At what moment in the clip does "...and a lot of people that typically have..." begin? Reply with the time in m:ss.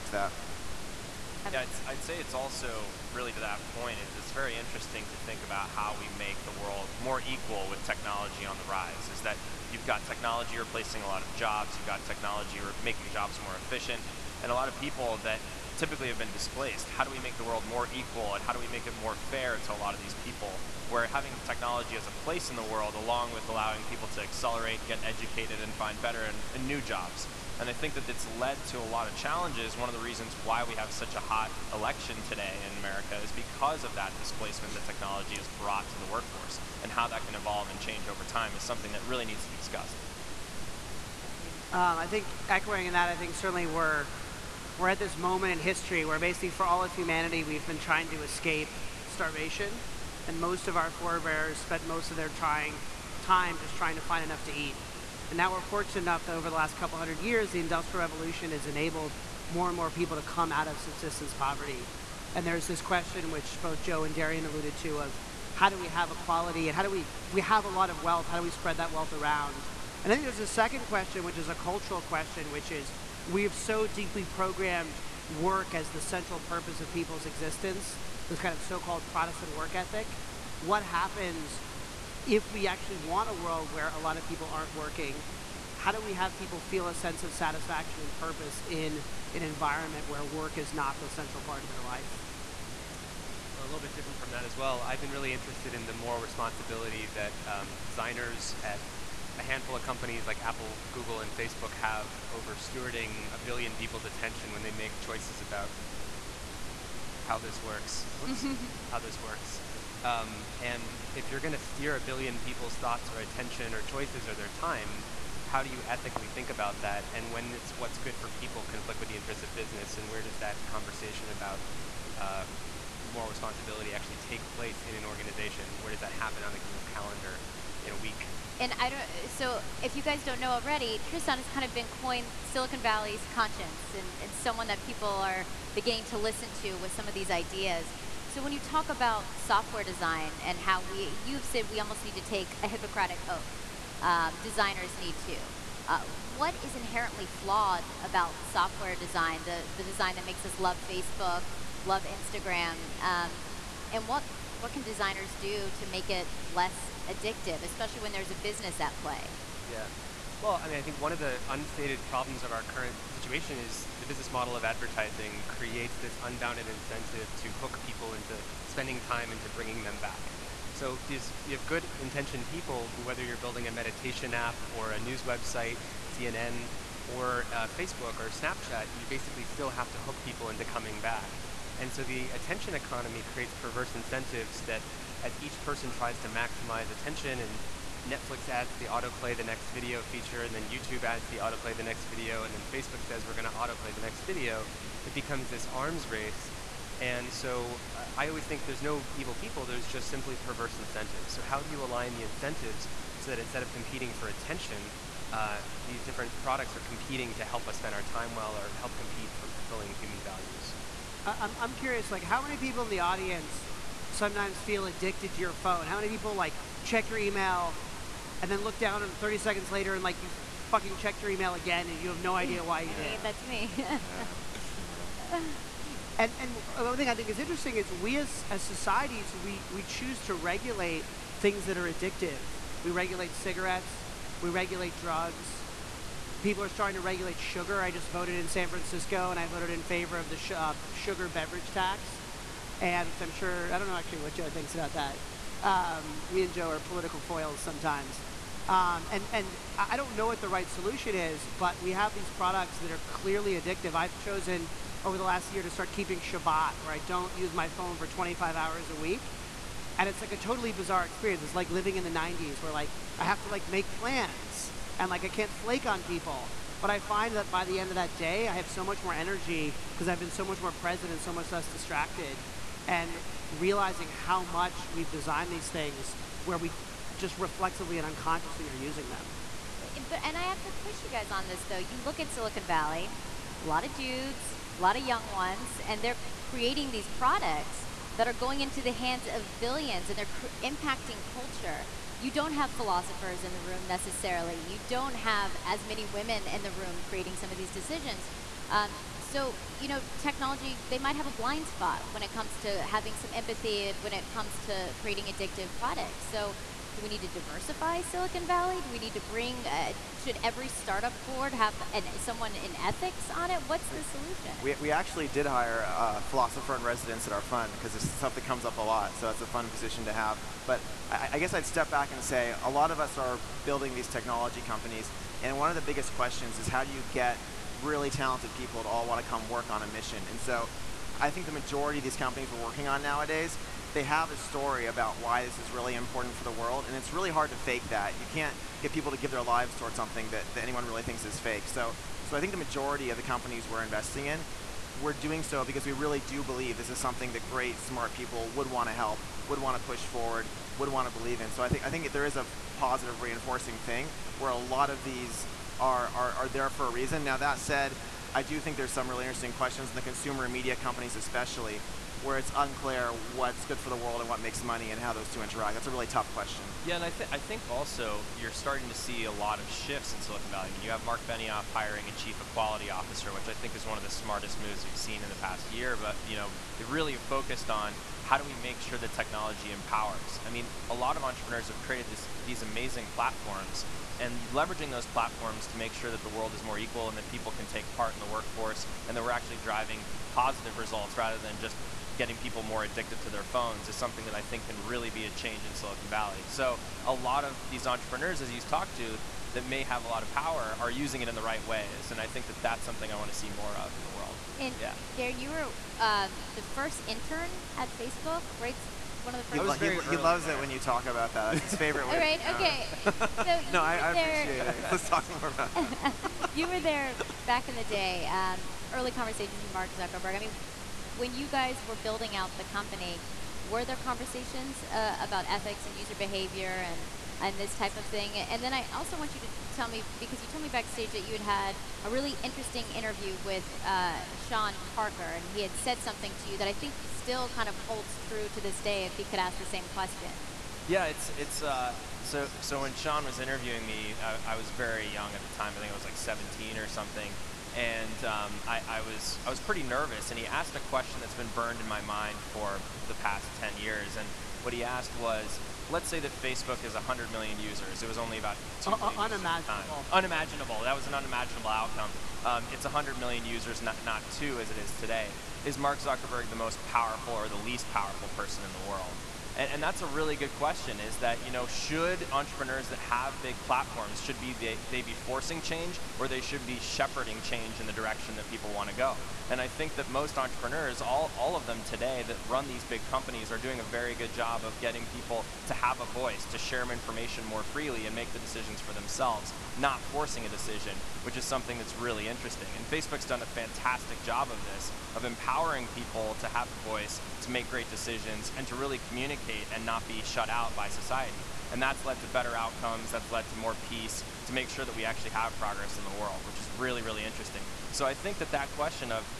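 0:14.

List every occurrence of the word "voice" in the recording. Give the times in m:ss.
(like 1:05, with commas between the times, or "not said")
8:06, 8:16.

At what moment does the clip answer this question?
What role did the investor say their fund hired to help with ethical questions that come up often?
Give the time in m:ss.
5:16.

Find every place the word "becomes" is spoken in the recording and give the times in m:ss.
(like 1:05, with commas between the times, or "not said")
3:15.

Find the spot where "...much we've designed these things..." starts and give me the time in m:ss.
4:34.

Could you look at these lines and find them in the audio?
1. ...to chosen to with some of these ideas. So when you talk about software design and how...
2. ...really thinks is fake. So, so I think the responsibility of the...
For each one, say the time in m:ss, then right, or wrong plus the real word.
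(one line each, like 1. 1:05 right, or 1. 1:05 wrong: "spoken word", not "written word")
1. 2:16 wrong: "listen", not "chosen"
2. 5:40 wrong: "majority", not "responsibility".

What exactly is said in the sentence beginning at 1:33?
Well, a little bit different from that as well.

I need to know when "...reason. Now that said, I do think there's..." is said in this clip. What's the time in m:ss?
5:56.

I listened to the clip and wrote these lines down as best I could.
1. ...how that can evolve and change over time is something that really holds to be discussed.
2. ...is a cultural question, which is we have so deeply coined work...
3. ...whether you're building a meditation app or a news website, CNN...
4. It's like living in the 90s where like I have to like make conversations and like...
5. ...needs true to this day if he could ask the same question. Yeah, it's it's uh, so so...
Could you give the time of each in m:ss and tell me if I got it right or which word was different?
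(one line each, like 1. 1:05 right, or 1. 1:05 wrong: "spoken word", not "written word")
1. 0:36 wrong: "needs", not "holds"
2. 1:11 wrong: "programmed", not "coined"
3. 2:53 right
4. 4:21 wrong: "plans", not "conversations"
5. 7:17 wrong: "holds", not "needs".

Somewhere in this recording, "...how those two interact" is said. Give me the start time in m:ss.
6:04.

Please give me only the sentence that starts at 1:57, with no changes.
And when does what's good for people conflict with the interests of business?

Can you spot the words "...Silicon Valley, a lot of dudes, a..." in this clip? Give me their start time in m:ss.
4:42.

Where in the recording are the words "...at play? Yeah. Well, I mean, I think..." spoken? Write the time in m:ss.
2:38.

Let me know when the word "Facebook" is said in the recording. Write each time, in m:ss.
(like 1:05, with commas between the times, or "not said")
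1:41, 2:30, 2:57, 3:12, 6:47, 7:36, 8:12.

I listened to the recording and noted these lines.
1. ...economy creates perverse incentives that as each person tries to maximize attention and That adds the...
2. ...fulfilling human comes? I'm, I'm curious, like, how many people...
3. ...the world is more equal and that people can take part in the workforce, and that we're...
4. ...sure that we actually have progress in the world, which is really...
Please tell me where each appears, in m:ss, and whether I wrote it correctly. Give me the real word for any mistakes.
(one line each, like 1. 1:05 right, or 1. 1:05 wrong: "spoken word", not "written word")
1. 3:02 wrong: "Netflix", not "That"
2. 3:29 wrong: "values", not "comes"
3. 6:26 right
4. 8:24 right.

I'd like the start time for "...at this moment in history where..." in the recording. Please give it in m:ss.
0:44.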